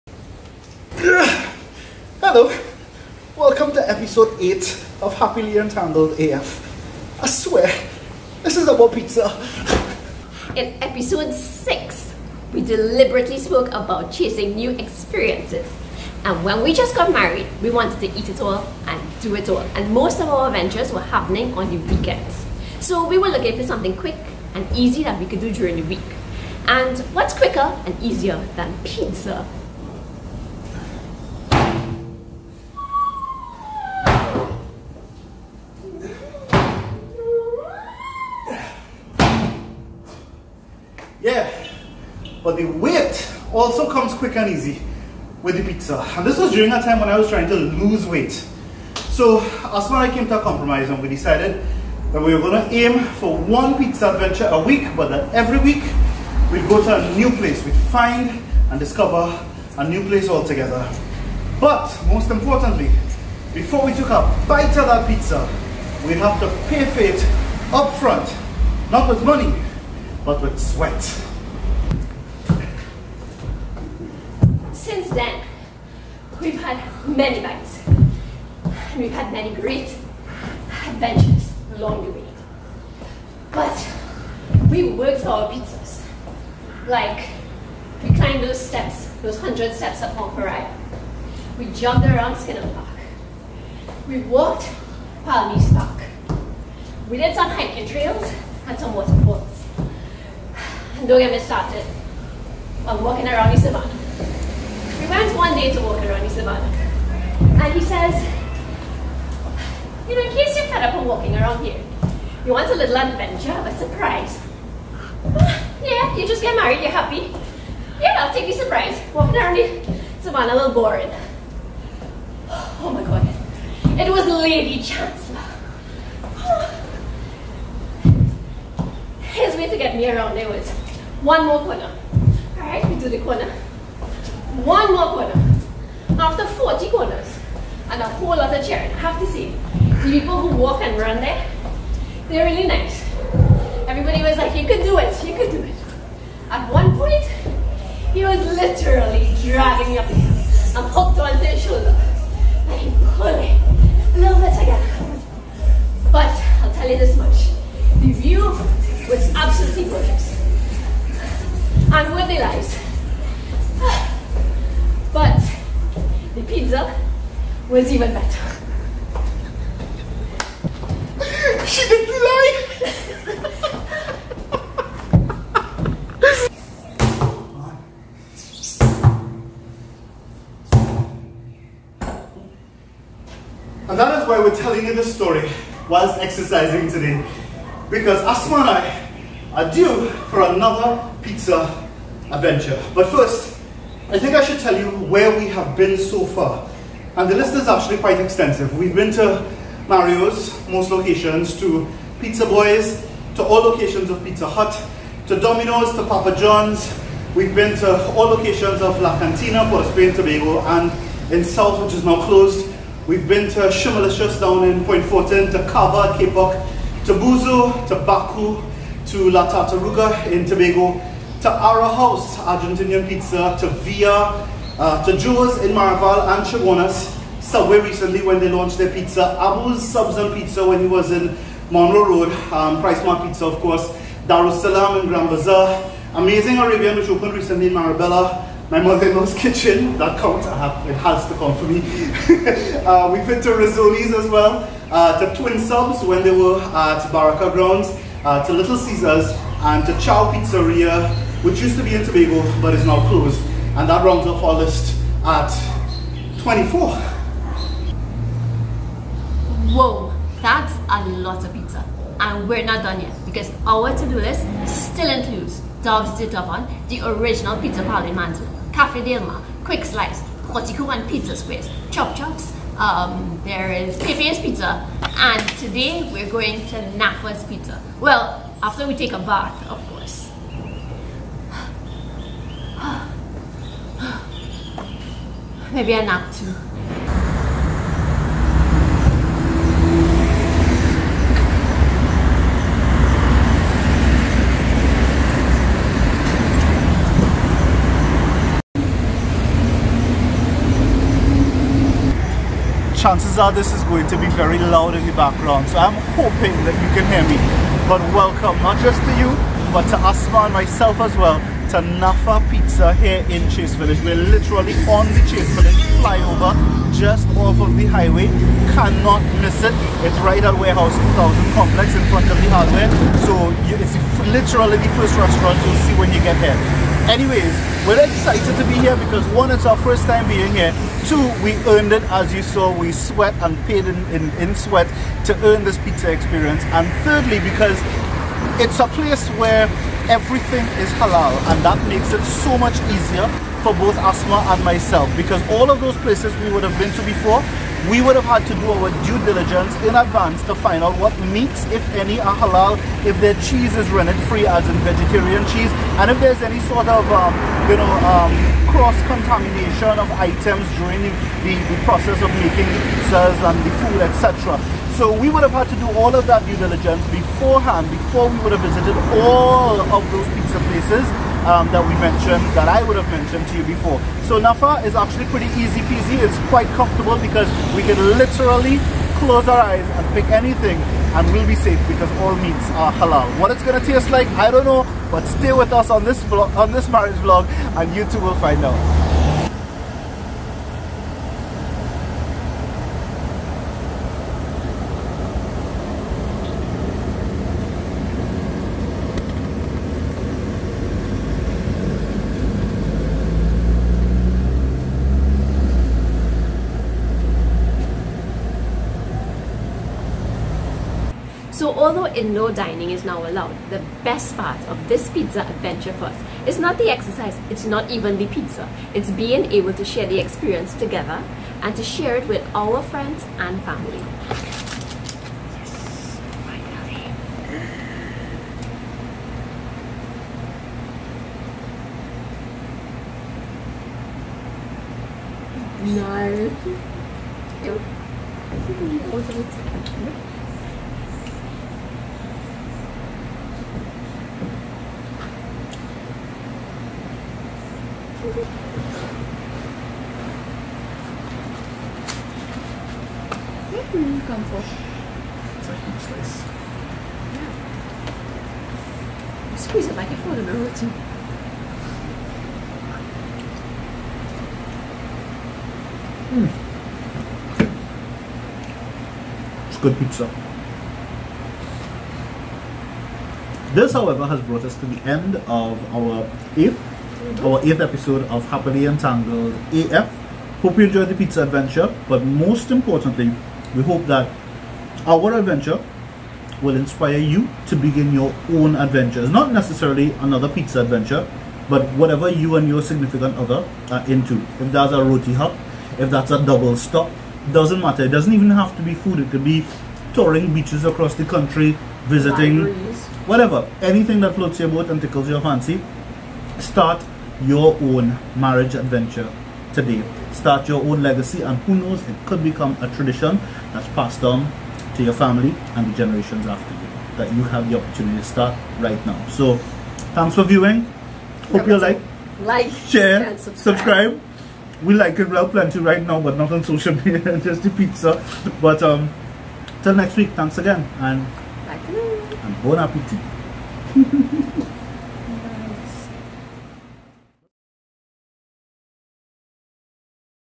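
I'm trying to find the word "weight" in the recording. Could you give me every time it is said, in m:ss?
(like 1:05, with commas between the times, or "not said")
0:42, 0:48.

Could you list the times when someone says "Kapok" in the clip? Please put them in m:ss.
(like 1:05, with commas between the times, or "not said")
3:36.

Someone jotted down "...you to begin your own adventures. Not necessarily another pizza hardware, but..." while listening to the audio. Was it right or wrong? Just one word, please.
wrong.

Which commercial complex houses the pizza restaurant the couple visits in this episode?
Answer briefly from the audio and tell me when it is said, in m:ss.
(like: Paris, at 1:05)
Warehouse 2000, at 5:20.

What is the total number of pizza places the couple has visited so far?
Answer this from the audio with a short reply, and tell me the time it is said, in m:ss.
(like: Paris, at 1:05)
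24, at 4:16.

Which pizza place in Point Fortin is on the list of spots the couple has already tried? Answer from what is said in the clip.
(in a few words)
Shimmerlicious.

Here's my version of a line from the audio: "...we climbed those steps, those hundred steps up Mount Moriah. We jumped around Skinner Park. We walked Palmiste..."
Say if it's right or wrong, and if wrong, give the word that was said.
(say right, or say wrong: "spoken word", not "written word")
right.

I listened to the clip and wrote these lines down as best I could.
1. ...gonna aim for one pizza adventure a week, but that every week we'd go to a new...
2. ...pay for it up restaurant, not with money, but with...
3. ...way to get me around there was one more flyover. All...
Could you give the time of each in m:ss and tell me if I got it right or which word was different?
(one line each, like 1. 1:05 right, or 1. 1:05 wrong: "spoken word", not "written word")
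1. 0:52 right
2. 1:06 wrong: "front", not "restaurant"
3. 2:09 wrong: "corner", not "flyover".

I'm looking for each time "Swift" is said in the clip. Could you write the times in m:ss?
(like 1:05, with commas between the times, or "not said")
not said.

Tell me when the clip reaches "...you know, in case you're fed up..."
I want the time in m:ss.
1:50.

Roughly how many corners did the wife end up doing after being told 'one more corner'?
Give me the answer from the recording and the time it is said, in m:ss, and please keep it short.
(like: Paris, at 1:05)
40, at 2:16.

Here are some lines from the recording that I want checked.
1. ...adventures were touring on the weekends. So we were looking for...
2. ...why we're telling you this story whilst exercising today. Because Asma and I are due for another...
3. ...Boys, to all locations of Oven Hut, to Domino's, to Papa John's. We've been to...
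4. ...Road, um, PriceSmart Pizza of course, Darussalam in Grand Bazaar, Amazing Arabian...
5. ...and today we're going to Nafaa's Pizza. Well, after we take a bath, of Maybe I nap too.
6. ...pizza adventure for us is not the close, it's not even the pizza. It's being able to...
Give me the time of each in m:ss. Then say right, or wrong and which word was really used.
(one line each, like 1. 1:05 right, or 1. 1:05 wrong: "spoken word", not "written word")
1. 0:20 wrong: "happening", not "touring"
2. 3:04 right
3. 3:22 wrong: "Pizza", not "Oven"
4. 3:52 right
5. 4:35 right
6. 6:55 wrong: "exercise", not "close".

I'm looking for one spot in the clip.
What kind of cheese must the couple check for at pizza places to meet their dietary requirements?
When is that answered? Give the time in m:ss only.
5:53.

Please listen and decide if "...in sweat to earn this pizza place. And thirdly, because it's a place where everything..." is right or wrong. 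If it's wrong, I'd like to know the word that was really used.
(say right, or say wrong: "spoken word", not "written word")
wrong: "experience", not "place".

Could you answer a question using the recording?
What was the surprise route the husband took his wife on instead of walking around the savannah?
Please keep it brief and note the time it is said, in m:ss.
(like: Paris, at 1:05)
Lady Chancellor, at 2:04.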